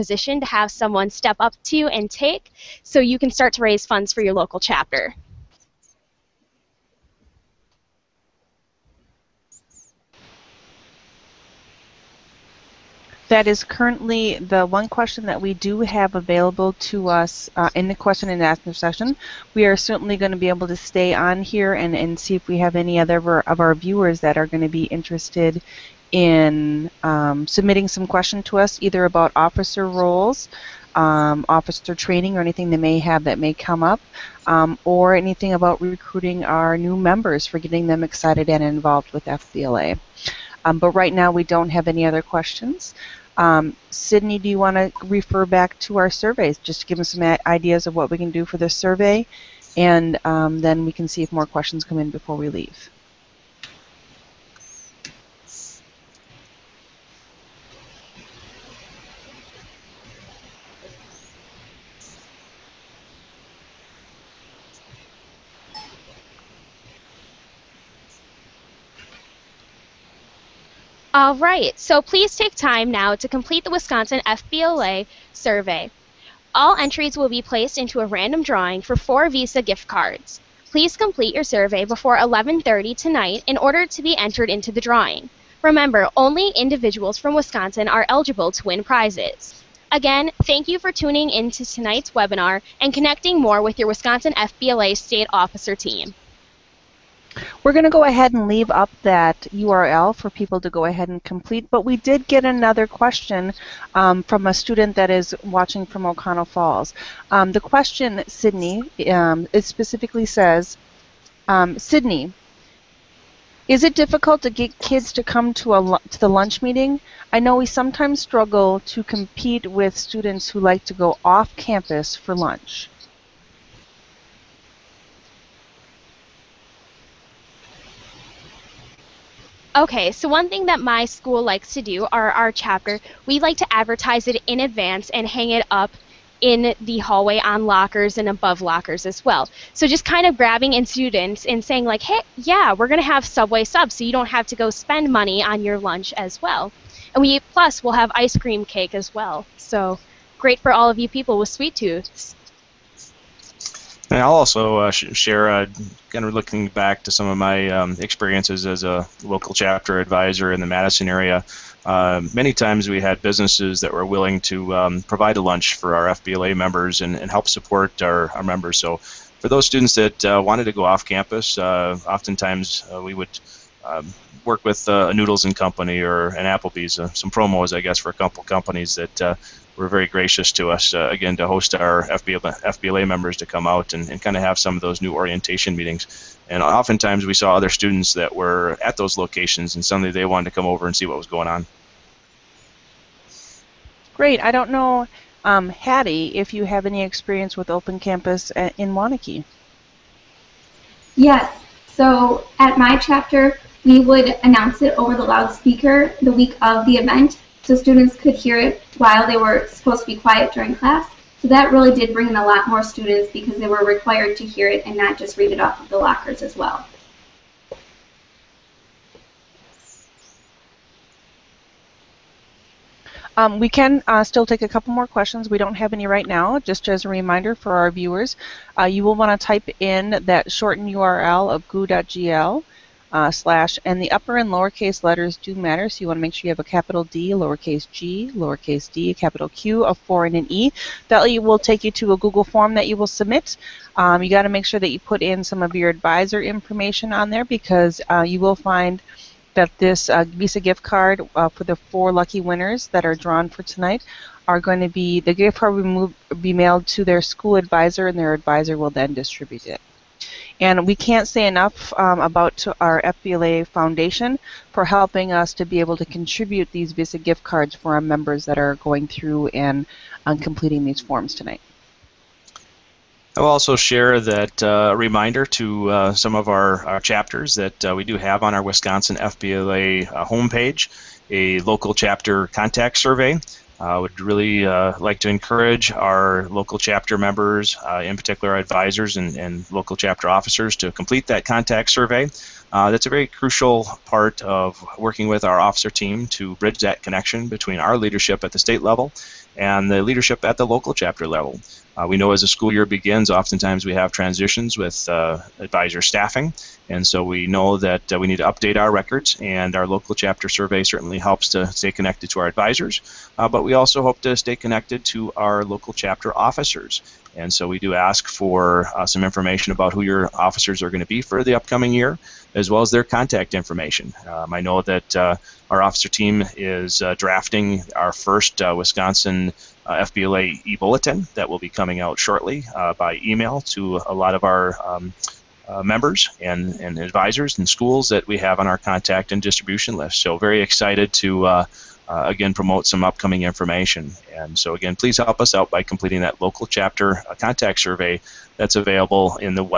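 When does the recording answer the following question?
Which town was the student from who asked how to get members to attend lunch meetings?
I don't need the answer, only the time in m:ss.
1:46.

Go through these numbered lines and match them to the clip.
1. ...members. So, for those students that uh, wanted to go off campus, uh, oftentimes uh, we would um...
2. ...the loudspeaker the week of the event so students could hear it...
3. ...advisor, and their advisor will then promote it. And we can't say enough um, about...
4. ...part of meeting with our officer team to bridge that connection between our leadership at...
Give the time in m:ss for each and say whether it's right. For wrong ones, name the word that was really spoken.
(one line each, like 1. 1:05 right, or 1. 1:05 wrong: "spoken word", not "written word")
1. 2:48 right
2. 3:25 right
3. 4:17 wrong: "distribute", not "promote"
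4. 4:54 wrong: "working", not "meeting".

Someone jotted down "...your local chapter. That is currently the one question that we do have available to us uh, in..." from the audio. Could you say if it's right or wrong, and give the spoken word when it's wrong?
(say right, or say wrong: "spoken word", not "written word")
right.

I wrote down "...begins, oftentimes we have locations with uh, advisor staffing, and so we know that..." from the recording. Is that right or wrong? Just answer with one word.
wrong.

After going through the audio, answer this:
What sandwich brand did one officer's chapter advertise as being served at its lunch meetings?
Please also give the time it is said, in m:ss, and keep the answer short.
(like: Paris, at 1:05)
Subway, at 2:23.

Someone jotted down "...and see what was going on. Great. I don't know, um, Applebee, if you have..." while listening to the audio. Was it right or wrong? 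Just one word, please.
wrong.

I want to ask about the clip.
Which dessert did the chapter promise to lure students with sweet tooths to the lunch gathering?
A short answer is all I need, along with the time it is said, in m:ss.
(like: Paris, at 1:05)
Ice cream cake, at 2:28.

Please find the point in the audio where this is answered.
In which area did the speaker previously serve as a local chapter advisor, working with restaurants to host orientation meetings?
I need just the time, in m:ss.
2:40.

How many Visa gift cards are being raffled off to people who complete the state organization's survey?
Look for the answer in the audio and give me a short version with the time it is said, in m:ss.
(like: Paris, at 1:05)
4, at 1:18.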